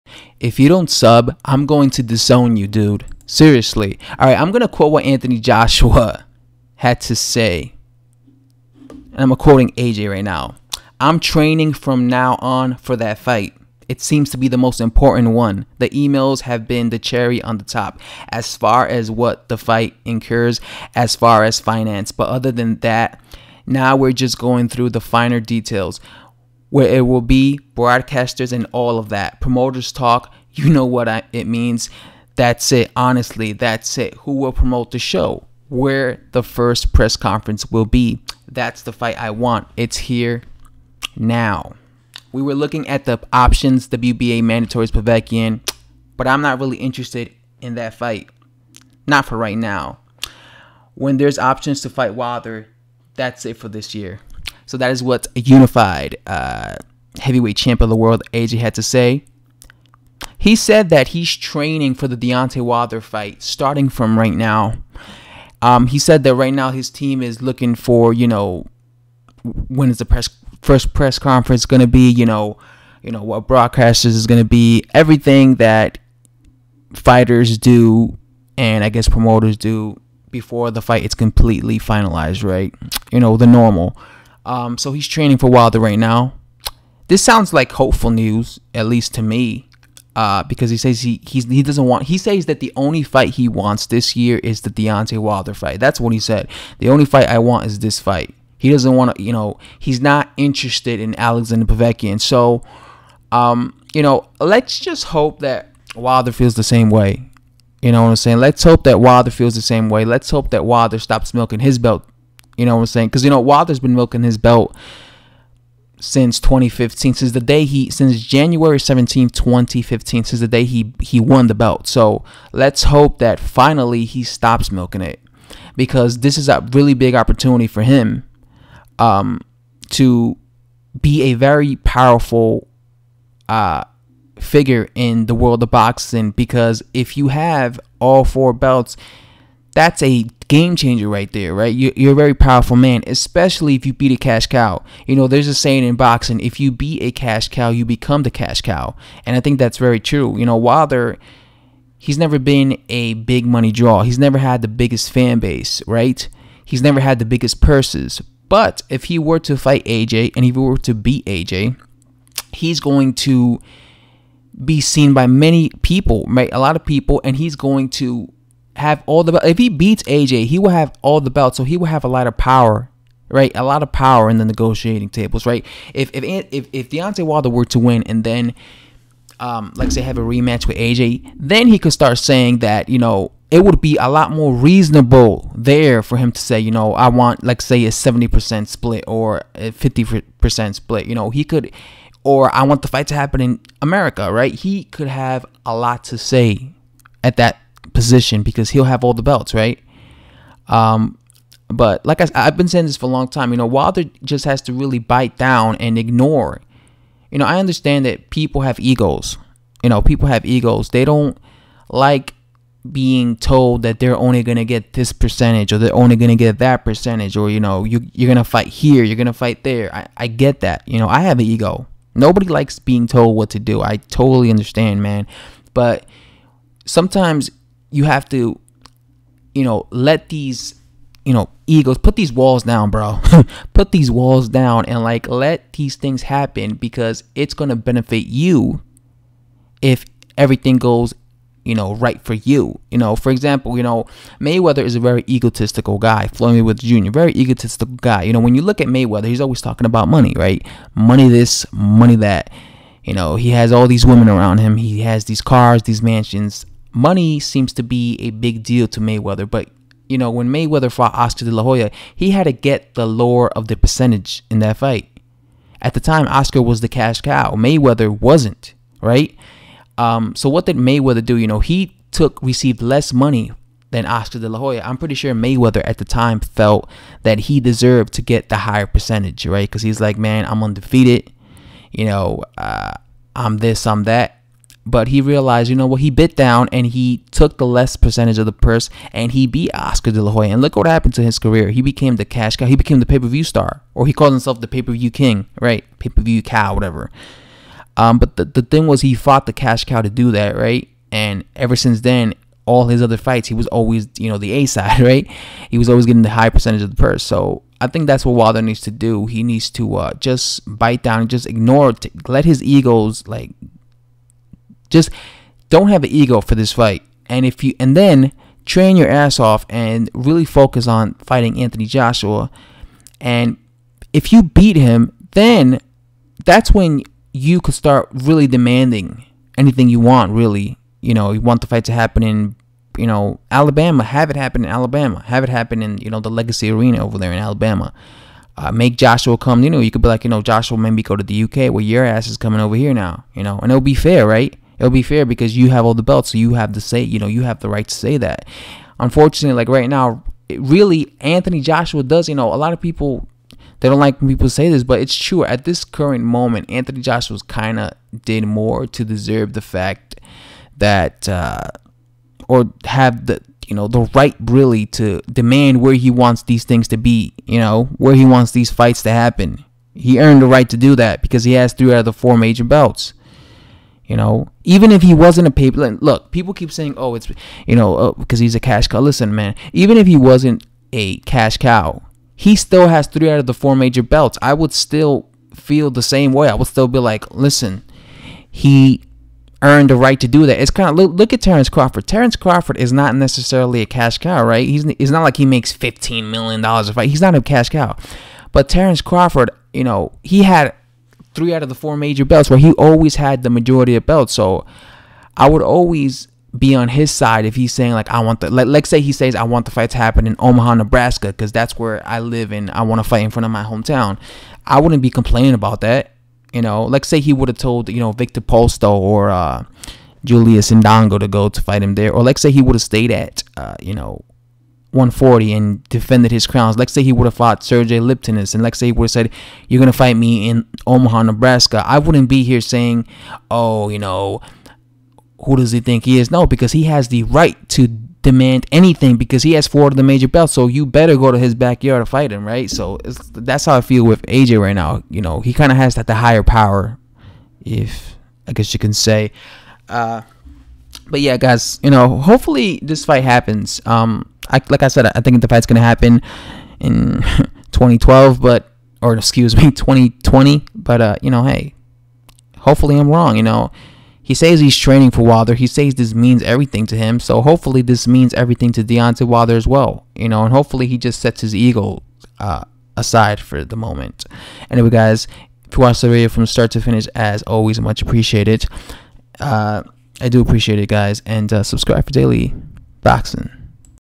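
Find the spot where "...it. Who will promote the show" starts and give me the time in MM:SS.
00:33.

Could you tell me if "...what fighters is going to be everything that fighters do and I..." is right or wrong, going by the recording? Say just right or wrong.
wrong.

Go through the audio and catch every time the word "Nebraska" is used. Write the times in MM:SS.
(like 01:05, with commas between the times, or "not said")
06:50, 07:11.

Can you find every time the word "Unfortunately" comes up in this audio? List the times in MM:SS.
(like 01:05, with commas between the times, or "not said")
05:48.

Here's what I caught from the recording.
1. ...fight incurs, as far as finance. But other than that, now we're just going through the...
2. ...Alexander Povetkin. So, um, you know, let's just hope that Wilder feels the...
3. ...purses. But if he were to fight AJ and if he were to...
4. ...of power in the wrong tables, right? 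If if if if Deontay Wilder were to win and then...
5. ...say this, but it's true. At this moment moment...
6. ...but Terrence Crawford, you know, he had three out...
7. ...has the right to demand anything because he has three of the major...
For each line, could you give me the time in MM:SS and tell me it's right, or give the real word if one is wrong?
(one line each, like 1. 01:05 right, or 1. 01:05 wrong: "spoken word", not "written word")
1. 00:19 right
2. 01:41 right
3. 02:37 right
4. 02:53 wrong: "negotiating", not "wrong"
5. 05:54 wrong: "current", not "moment"
6. 06:38 right
7. 07:16 wrong: "four", not "three".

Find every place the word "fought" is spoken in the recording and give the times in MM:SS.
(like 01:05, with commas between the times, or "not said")
04:20, 04:59, 07:07.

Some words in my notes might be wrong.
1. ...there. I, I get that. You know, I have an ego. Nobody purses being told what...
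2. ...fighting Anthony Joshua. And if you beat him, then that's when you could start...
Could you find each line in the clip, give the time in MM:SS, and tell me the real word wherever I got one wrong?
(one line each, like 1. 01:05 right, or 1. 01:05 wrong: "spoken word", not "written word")
1. 03:39 wrong: "likes", not "purses"
2. 05:21 right.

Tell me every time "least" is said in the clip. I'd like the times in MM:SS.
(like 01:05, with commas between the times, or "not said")
01:28.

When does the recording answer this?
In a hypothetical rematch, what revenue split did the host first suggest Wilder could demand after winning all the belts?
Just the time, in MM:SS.
03:07.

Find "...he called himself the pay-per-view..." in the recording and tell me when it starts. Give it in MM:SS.
04:54.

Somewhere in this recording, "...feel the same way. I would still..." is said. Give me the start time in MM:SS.
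06:25.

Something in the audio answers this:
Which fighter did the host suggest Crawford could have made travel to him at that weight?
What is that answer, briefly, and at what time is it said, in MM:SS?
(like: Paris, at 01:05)
Sergey Lipinets, at 07:07.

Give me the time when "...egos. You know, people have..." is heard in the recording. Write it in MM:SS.
03:28.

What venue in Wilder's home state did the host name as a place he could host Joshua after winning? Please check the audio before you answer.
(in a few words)
Legacy Arena.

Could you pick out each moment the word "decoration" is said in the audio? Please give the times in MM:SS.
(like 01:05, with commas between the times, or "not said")
not said.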